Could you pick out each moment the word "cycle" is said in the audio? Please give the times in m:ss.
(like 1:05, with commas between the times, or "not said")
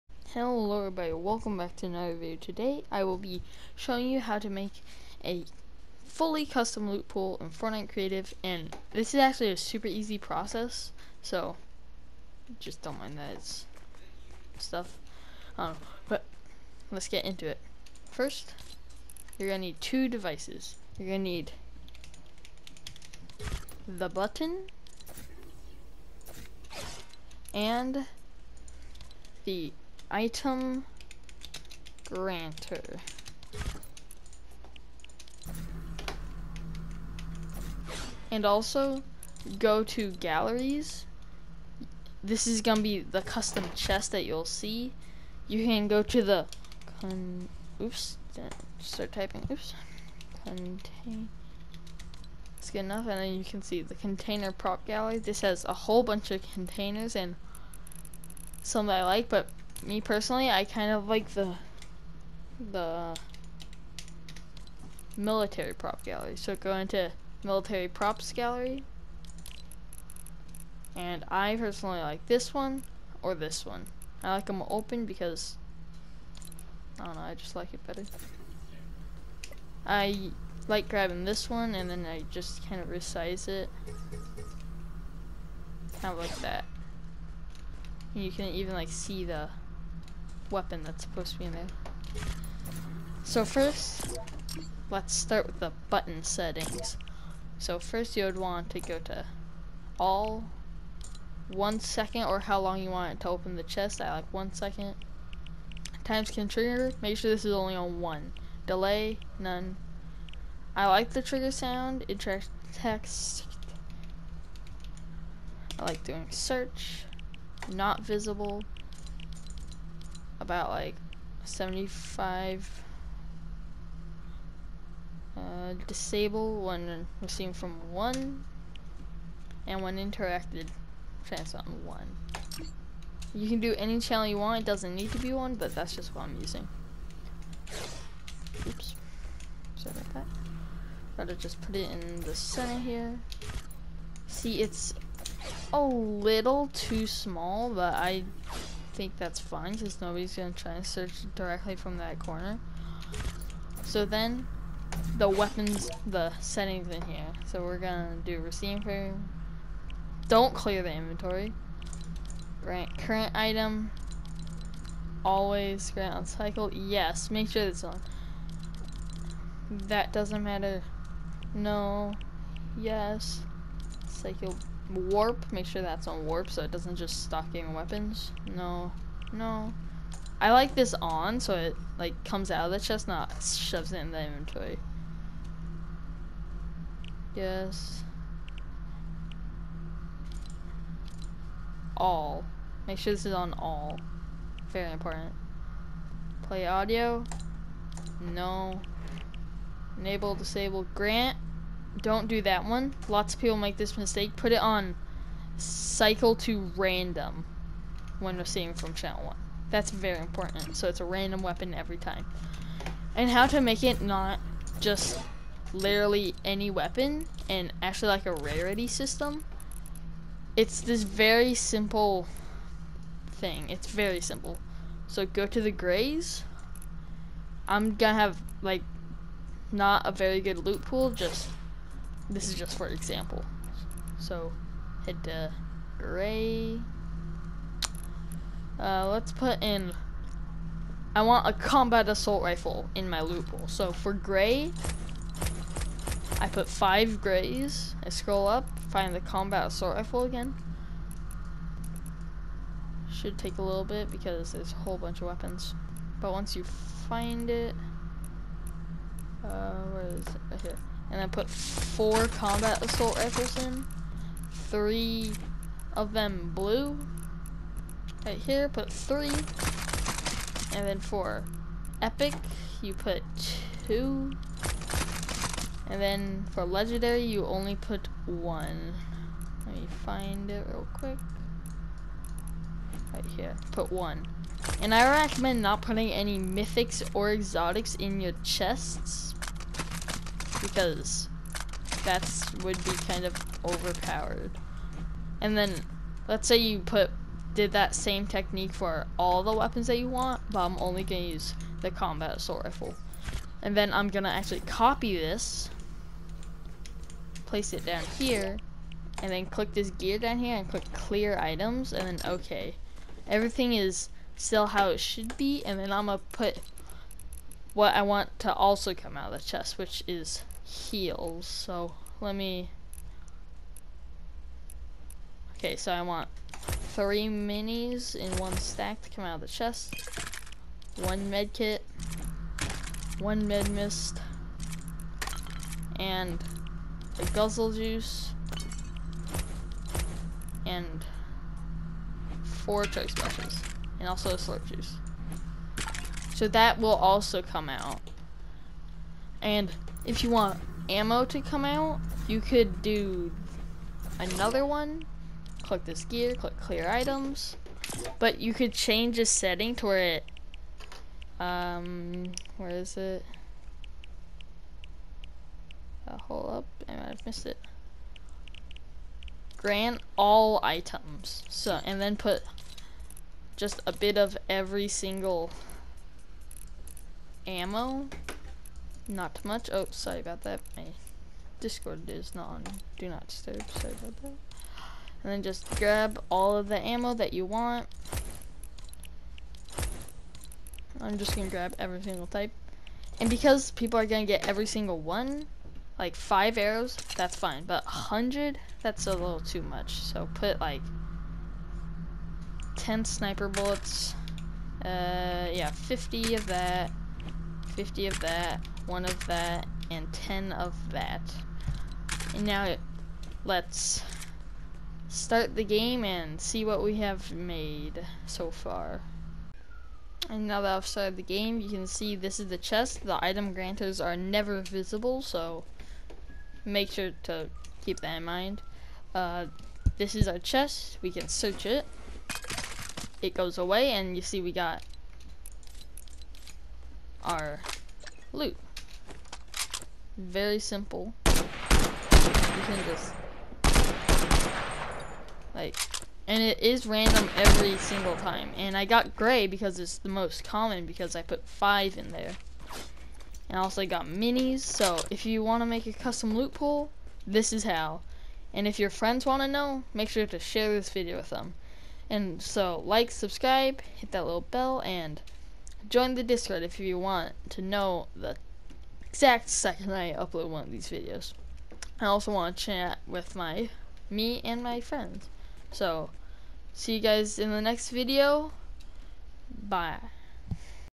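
2:46, 2:54, 3:25.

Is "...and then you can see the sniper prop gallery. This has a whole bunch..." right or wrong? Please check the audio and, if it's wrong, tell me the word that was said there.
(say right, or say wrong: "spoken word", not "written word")
wrong: "container", not "sniper".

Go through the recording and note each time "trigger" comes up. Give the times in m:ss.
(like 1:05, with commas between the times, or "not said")
1:46, 1:51.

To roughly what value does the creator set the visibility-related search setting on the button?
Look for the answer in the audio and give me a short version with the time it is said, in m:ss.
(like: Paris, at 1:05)
75, at 2:01.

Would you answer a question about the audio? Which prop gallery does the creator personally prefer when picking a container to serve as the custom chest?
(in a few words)
Military props gallery.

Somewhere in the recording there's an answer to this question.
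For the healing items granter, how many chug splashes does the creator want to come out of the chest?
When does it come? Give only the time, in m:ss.
5:42.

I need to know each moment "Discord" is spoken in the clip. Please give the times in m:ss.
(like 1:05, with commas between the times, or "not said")
6:21, 7:46.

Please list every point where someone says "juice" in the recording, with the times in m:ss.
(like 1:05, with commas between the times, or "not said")
5:37, 5:44.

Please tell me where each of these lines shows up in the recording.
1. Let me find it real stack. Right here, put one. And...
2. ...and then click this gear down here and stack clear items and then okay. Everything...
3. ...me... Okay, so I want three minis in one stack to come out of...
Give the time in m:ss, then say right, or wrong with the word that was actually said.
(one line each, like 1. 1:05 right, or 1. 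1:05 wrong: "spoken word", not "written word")
1. 4:39 wrong: "quick", not "stack"
2. 5:09 wrong: "click", not "stack"
3. 5:22 right.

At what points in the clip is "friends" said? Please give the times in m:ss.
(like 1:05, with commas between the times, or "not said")
7:38, 7:54.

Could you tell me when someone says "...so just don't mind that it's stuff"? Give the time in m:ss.
0:11.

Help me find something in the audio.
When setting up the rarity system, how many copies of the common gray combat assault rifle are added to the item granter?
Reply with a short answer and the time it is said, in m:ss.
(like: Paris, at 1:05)
5, at 4:06.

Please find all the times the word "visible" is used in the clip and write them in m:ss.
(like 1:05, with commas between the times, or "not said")
1:58, 7:04.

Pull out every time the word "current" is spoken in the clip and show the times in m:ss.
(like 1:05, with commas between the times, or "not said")
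2:42.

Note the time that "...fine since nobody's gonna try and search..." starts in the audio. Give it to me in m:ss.
2:29.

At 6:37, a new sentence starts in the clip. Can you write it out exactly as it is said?
But 100, that's a little too much.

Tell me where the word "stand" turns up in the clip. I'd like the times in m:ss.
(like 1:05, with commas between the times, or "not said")
not said.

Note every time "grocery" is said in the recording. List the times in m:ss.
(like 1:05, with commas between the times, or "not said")
not said.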